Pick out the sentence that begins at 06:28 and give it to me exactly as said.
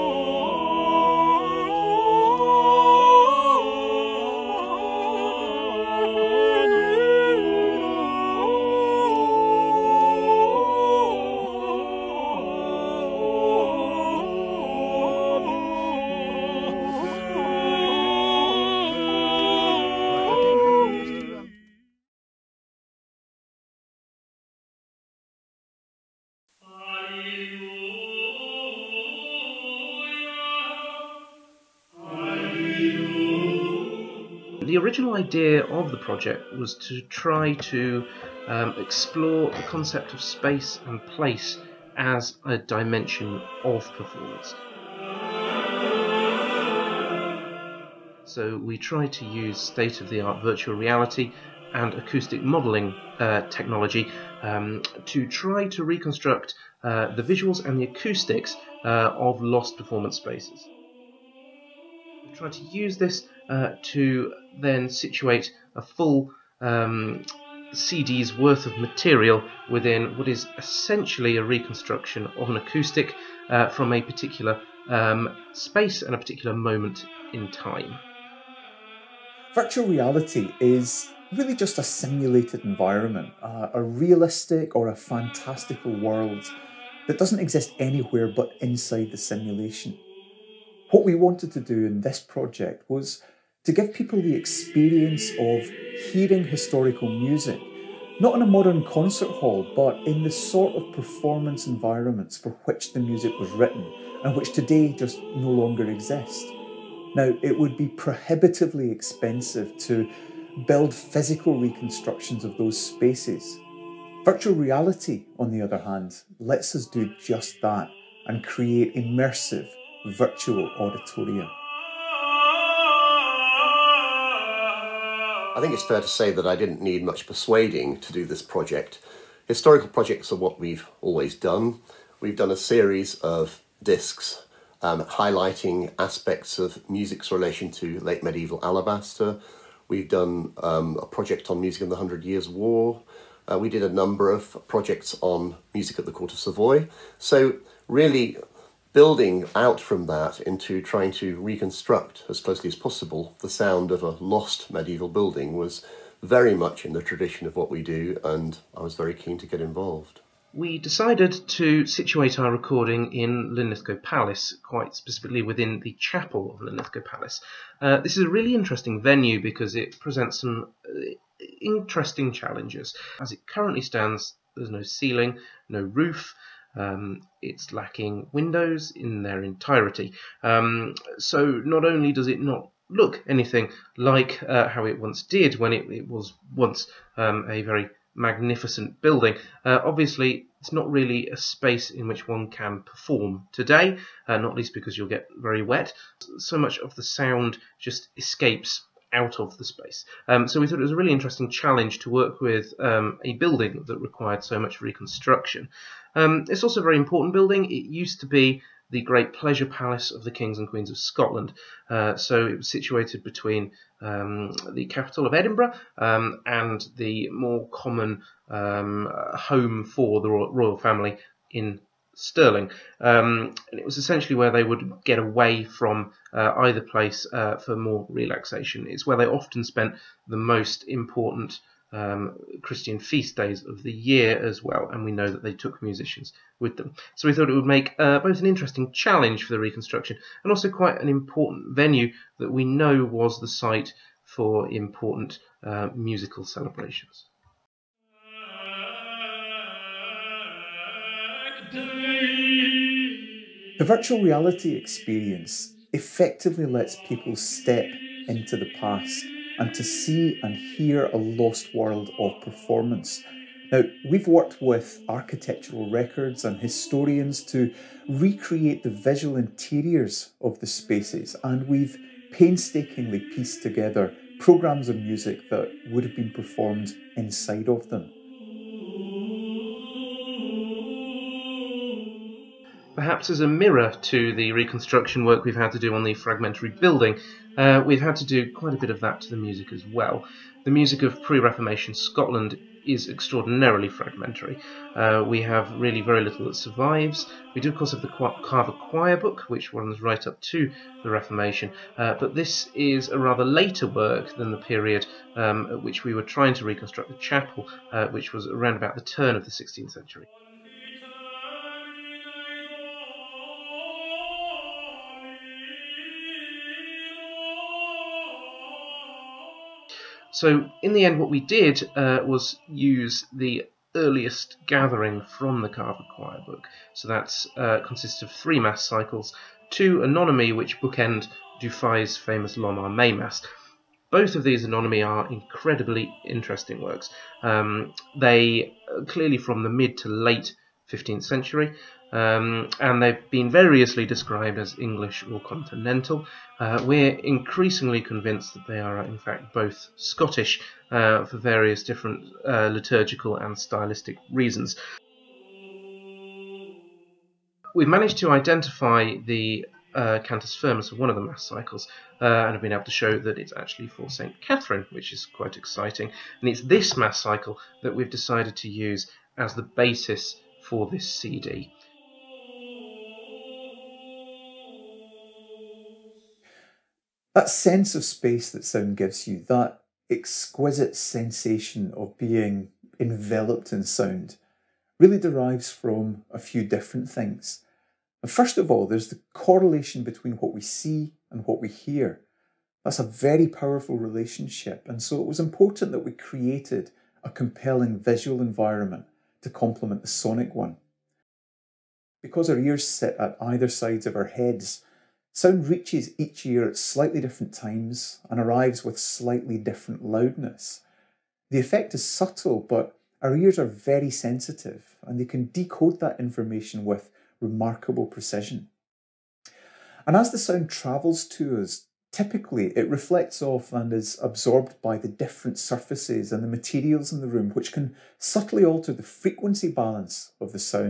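And first of all, there's the correlation between what we see and what we hear.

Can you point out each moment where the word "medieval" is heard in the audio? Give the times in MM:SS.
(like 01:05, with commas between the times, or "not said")
02:18, 02:34.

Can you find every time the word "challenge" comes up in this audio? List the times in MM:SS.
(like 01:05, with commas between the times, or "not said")
02:52, 03:21, 03:58.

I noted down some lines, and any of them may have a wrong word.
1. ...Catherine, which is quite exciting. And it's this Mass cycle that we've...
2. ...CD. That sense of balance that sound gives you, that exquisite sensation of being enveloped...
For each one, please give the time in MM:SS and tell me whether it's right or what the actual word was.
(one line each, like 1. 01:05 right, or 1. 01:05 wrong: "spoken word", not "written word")
1. 06:04 right
2. 06:11 wrong: "space", not "balance".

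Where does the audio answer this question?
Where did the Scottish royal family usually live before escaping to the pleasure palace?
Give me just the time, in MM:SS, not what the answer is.
03:42.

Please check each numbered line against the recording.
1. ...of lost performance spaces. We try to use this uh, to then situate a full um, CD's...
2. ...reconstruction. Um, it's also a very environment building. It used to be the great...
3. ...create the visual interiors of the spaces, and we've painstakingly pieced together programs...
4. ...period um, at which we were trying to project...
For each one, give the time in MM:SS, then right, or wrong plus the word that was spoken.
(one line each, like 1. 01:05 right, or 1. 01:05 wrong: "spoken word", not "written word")
1. 00:59 right
2. 03:24 wrong: "important", not "environment"
3. 04:28 wrong: "recreate", not "create"
4. 05:04 wrong: "reconstruct", not "project".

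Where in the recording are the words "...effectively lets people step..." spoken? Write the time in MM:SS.
04:15.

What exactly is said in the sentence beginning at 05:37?
Um, they uh, clearly from the mid to late 15th century.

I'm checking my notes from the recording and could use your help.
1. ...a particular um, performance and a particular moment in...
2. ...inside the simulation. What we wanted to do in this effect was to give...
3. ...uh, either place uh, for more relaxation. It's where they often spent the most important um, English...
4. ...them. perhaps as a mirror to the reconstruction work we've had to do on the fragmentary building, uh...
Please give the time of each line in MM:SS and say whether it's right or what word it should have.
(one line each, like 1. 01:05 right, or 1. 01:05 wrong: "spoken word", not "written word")
1. 01:13 wrong: "space", not "performance"
2. 01:28 wrong: "project", not "effect"
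3. 03:46 wrong: "Christian", not "English"
4. 04:37 right.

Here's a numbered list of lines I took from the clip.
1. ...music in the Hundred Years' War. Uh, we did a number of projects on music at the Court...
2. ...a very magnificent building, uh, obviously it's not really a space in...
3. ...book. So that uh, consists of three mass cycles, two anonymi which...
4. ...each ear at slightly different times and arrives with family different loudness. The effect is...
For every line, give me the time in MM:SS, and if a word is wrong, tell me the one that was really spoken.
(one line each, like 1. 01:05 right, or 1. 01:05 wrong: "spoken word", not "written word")
1. 02:21 right
2. 03:07 right
3. 05:26 right
4. 06:46 wrong: "slightly", not "family".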